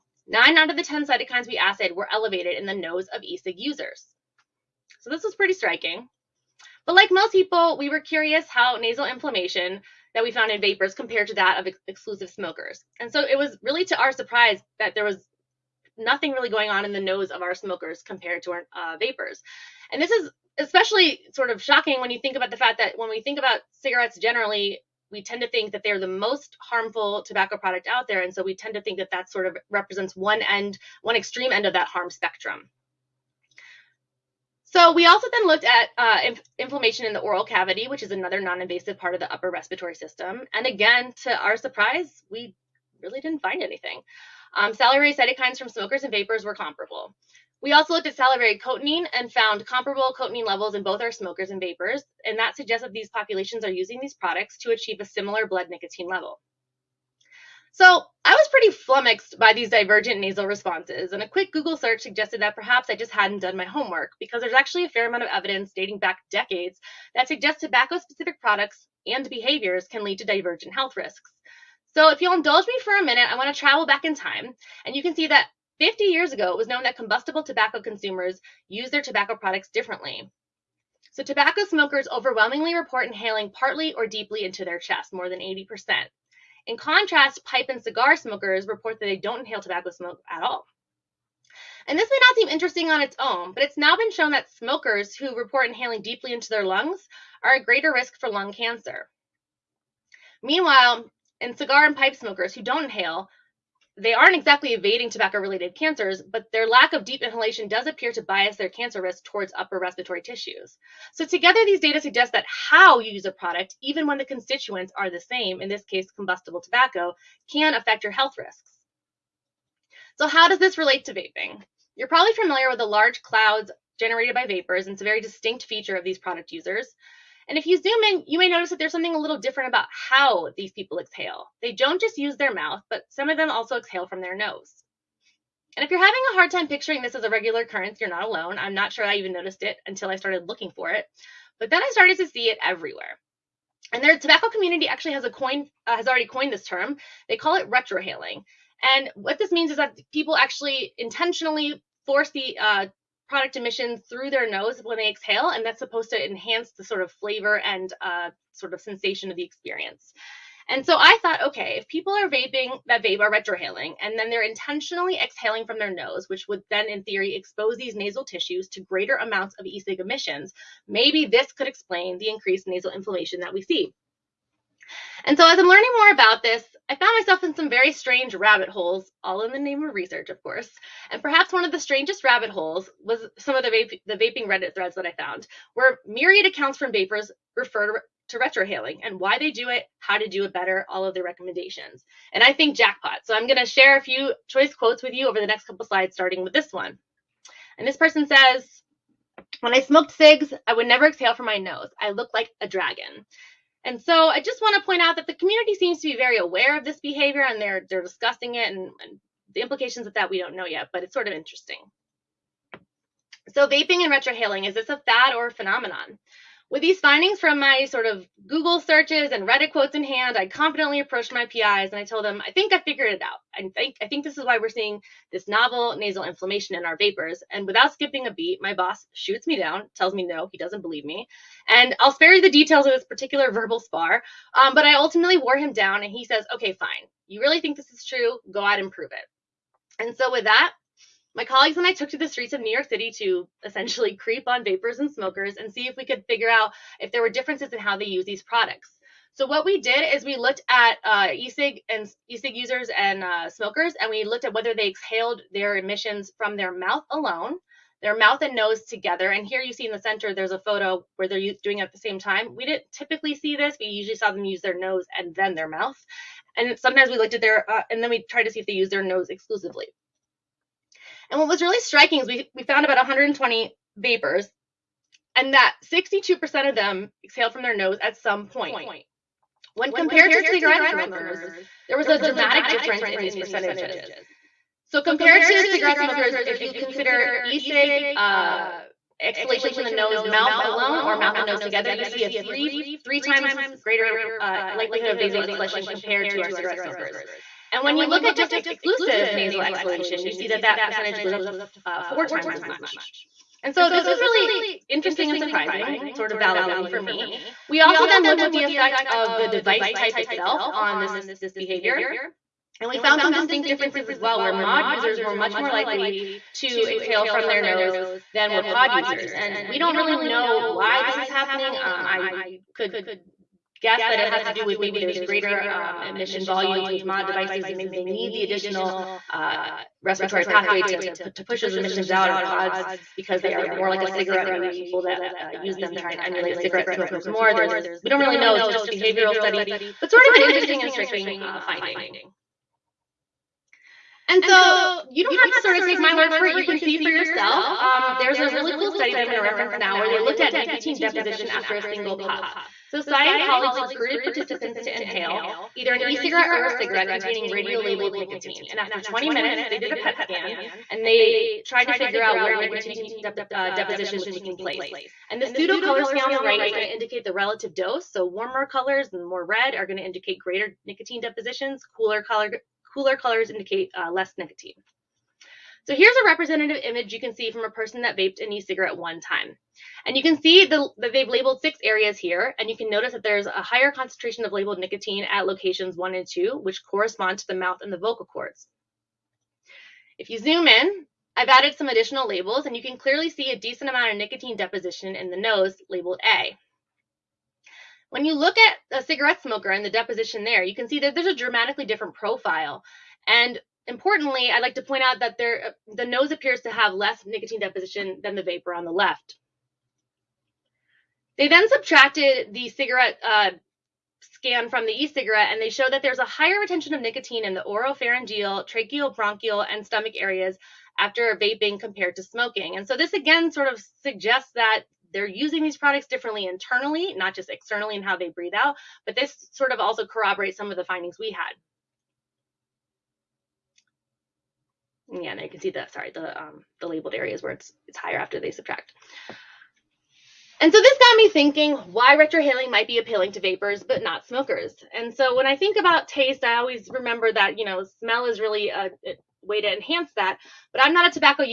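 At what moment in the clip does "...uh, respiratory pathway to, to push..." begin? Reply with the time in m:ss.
5:29.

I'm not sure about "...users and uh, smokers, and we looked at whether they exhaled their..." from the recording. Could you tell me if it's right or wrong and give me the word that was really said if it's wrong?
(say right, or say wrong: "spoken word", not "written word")
right.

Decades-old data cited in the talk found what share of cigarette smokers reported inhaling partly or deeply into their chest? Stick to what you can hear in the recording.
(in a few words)
more than 80%.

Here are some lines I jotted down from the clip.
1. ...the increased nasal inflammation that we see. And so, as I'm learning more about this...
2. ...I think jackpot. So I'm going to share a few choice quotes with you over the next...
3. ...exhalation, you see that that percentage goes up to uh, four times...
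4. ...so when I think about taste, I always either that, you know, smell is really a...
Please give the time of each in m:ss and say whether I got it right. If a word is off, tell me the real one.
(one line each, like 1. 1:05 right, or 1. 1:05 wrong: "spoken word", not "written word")
1. 2:52 right
2. 3:12 right
3. 4:59 right
4. 7:25 wrong: "remember", not "either".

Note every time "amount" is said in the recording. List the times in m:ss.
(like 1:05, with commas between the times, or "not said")
1:05, 2:49, 6:33.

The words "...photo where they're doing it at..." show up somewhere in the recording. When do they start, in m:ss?
4:20.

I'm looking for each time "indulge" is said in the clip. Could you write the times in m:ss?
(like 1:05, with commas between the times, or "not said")
1:12.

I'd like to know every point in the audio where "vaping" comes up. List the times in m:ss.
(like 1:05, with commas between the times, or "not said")
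2:01, 2:42, 3:04, 3:33, 7:01.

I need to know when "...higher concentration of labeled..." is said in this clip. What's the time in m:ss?
6:23.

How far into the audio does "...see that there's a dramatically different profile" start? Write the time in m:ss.
6:40.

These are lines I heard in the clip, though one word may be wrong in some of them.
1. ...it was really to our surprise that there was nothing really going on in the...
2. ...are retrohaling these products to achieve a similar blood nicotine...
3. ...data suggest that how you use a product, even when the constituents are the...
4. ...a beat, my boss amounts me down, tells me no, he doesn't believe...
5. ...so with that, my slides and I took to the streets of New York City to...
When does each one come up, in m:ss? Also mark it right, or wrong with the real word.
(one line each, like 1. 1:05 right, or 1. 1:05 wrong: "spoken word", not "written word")
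1. 0:13 right
2. 0:53 wrong: "using", not "retrohaling"
3. 1:51 right
4. 3:48 wrong: "shoots", not "amounts"
5. 4:00 wrong: "colleagues", not "slides".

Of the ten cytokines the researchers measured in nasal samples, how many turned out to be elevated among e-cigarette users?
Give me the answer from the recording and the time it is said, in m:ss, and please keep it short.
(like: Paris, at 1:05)
9, at 0:00.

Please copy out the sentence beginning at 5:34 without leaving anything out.
Maybe people that uh, use them try and emulate cigarette smokers more.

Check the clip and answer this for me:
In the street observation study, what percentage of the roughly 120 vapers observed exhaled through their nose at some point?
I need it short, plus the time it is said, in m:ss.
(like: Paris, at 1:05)
62%, at 4:35.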